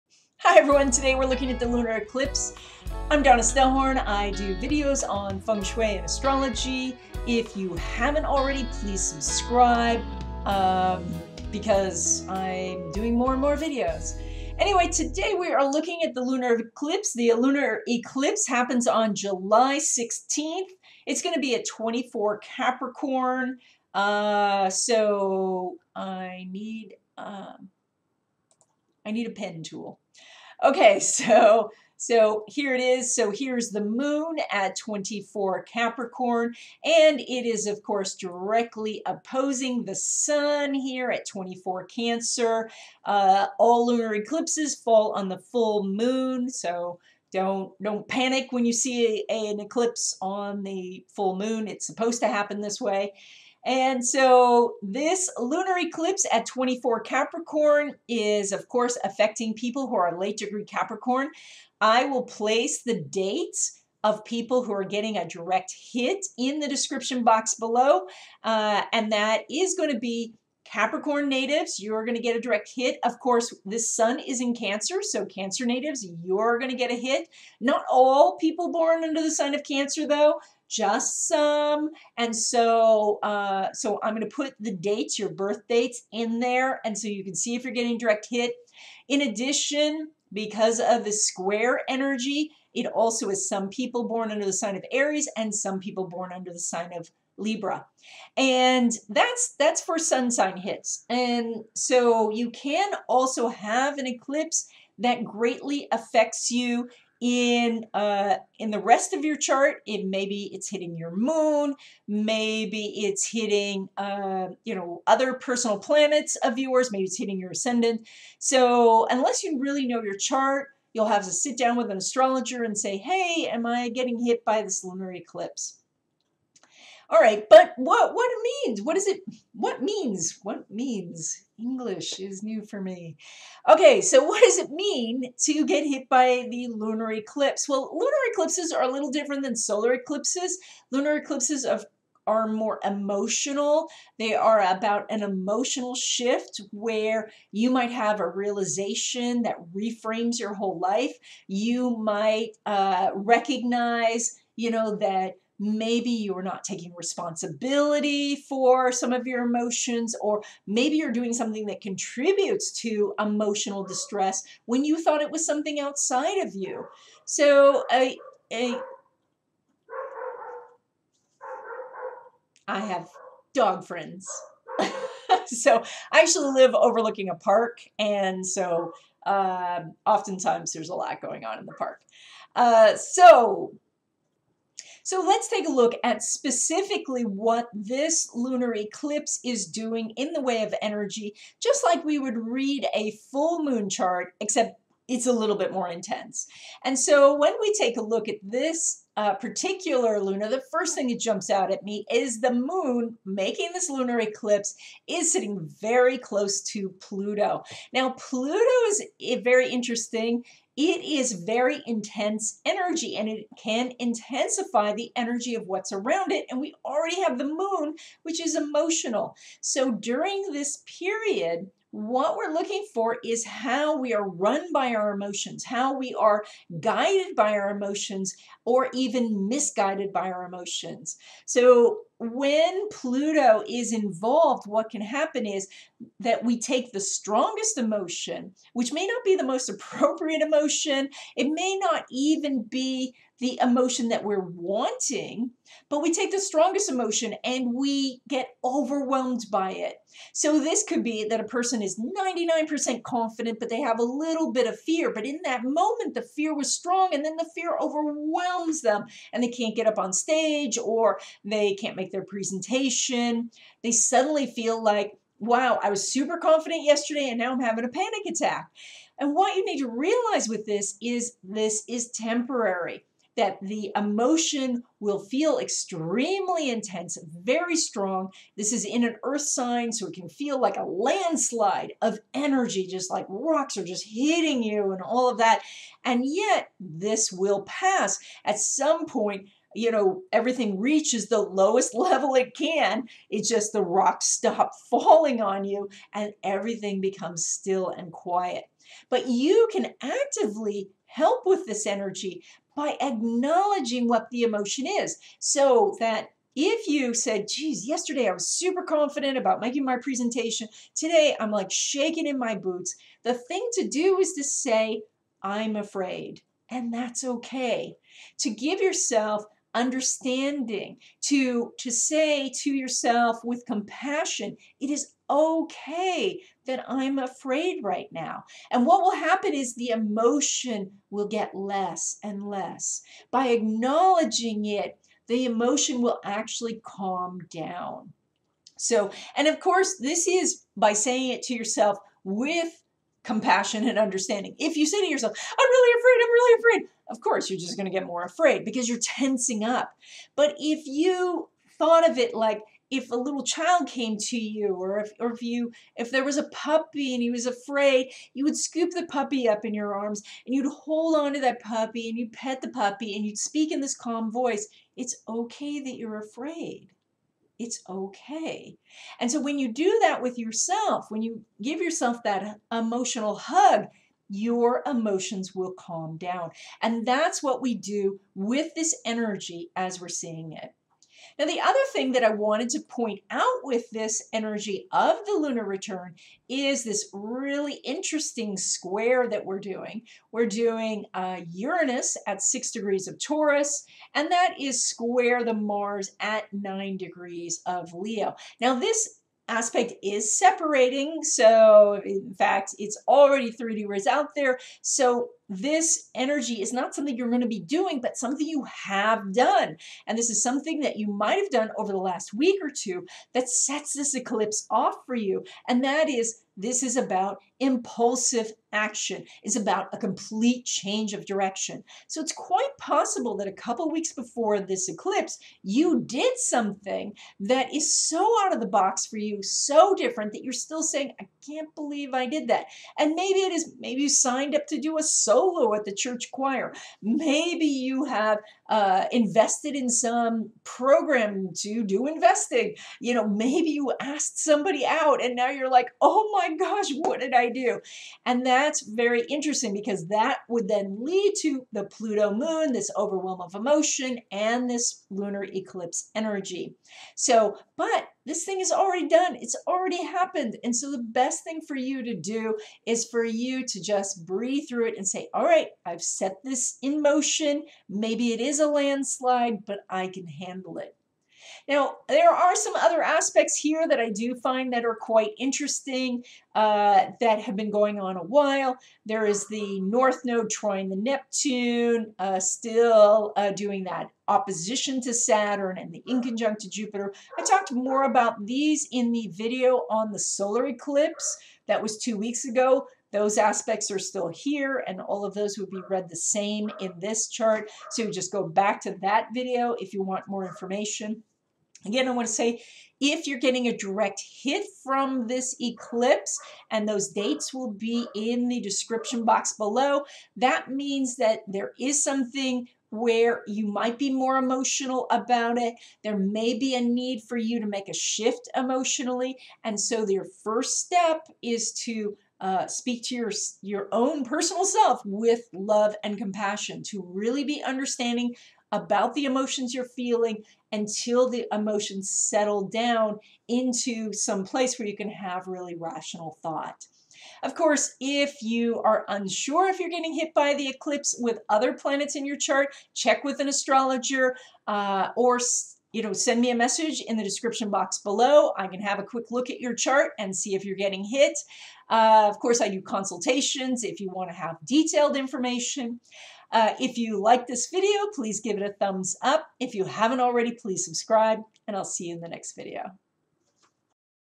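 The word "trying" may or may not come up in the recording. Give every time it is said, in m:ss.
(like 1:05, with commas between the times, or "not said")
8:00.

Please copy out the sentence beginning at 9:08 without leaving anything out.
I can have a quick look at your chart and see if you're getting hit.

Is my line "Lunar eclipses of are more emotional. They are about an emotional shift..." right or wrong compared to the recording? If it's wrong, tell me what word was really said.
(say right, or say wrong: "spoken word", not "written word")
right.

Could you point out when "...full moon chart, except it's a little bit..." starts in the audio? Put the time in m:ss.
3:13.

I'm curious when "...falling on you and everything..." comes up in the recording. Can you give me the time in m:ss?
4:54.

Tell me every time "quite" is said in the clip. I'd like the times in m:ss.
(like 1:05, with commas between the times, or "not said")
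7:02, 7:54.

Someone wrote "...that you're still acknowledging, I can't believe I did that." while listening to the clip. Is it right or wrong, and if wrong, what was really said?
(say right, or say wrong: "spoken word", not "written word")
wrong: "saying", not "acknowledging".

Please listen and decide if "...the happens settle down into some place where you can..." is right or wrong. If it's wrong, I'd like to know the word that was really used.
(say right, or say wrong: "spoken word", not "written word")
wrong: "emotions", not "happens".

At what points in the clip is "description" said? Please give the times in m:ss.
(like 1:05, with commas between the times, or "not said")
1:06, 8:28, 9:07.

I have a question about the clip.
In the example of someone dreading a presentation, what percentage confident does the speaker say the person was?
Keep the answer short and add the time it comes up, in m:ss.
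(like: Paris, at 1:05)
99%, at 4:11.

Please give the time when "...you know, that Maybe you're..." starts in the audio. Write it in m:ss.
2:34.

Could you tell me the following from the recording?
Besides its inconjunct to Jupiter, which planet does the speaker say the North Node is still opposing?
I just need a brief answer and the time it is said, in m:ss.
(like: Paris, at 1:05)
Saturn, at 8:05.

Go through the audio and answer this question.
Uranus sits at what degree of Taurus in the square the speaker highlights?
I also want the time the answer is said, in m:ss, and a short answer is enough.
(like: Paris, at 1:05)
6, at 6:32.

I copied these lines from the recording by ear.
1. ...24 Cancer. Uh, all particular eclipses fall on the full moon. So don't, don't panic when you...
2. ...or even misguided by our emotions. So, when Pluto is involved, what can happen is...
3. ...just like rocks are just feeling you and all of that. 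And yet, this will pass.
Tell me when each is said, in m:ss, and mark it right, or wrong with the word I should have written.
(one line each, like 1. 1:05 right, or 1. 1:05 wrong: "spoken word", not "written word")
1. 0:41 wrong: "lunar", not "particular"
2. 3:48 right
3. 4:42 wrong: "hitting", not "feeling".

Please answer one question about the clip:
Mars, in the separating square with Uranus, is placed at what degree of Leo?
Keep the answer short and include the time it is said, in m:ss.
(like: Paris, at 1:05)
9, at 6:36.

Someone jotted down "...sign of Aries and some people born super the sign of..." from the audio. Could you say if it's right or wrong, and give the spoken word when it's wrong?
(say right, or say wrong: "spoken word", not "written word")
wrong: "under", not "super".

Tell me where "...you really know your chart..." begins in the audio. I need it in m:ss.
1:59.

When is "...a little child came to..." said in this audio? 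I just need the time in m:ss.
5:53.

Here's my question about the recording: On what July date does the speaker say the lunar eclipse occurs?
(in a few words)
July 16.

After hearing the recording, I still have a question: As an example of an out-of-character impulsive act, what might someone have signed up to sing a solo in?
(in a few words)
The church choir.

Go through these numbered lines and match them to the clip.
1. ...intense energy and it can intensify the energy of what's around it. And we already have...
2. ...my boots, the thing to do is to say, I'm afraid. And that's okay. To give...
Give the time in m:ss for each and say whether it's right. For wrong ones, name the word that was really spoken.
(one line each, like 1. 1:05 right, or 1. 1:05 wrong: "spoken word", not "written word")
1. 3:31 right
2. 5:12 right.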